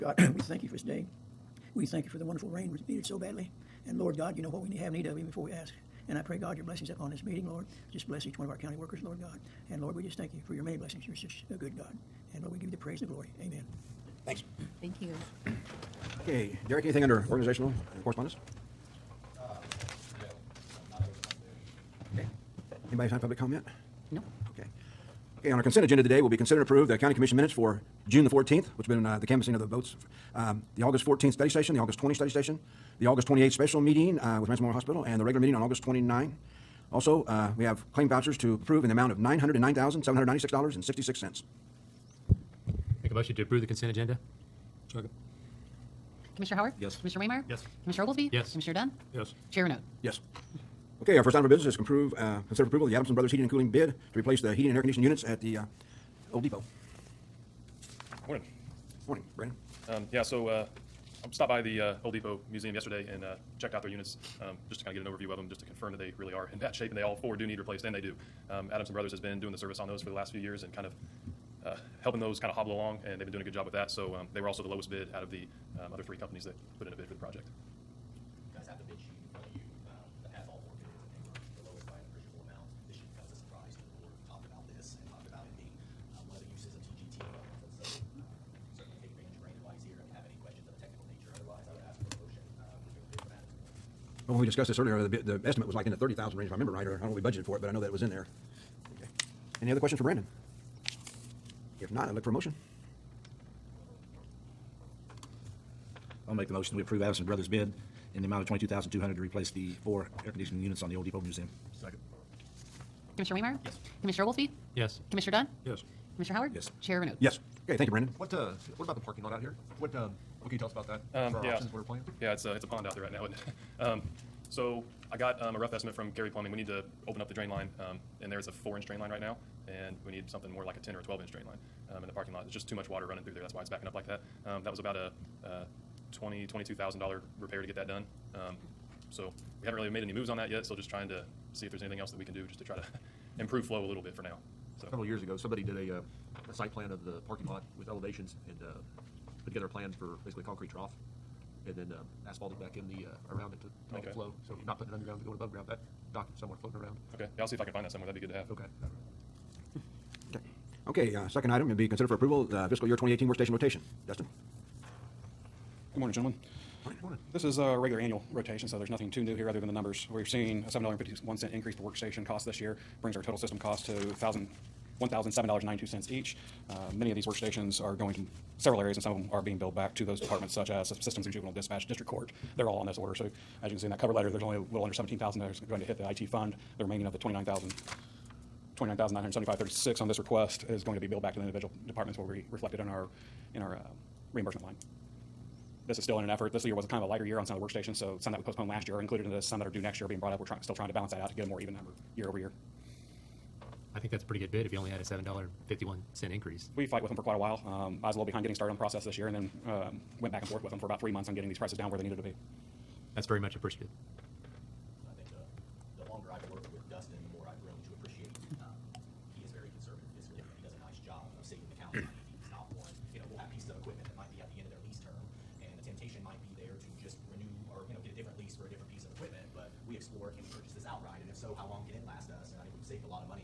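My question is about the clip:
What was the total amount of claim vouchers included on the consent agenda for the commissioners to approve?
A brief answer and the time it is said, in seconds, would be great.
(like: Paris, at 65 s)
$909,796.66, at 39 s.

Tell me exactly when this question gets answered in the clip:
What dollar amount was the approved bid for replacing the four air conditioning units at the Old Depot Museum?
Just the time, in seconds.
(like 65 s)
108 s.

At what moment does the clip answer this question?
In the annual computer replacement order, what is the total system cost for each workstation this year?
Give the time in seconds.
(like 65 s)
173 s.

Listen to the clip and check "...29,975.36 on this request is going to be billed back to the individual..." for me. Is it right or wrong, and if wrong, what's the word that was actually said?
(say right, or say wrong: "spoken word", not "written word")
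right.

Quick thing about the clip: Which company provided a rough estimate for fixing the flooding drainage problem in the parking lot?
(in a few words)
Kerry Plumbing.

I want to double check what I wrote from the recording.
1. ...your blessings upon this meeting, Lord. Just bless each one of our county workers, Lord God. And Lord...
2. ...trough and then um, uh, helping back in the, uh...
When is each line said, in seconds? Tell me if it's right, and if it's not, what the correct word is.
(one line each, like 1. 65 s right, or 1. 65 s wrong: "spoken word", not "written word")
1. 6 s right
2. 150 s wrong: "asphalting", not "helping".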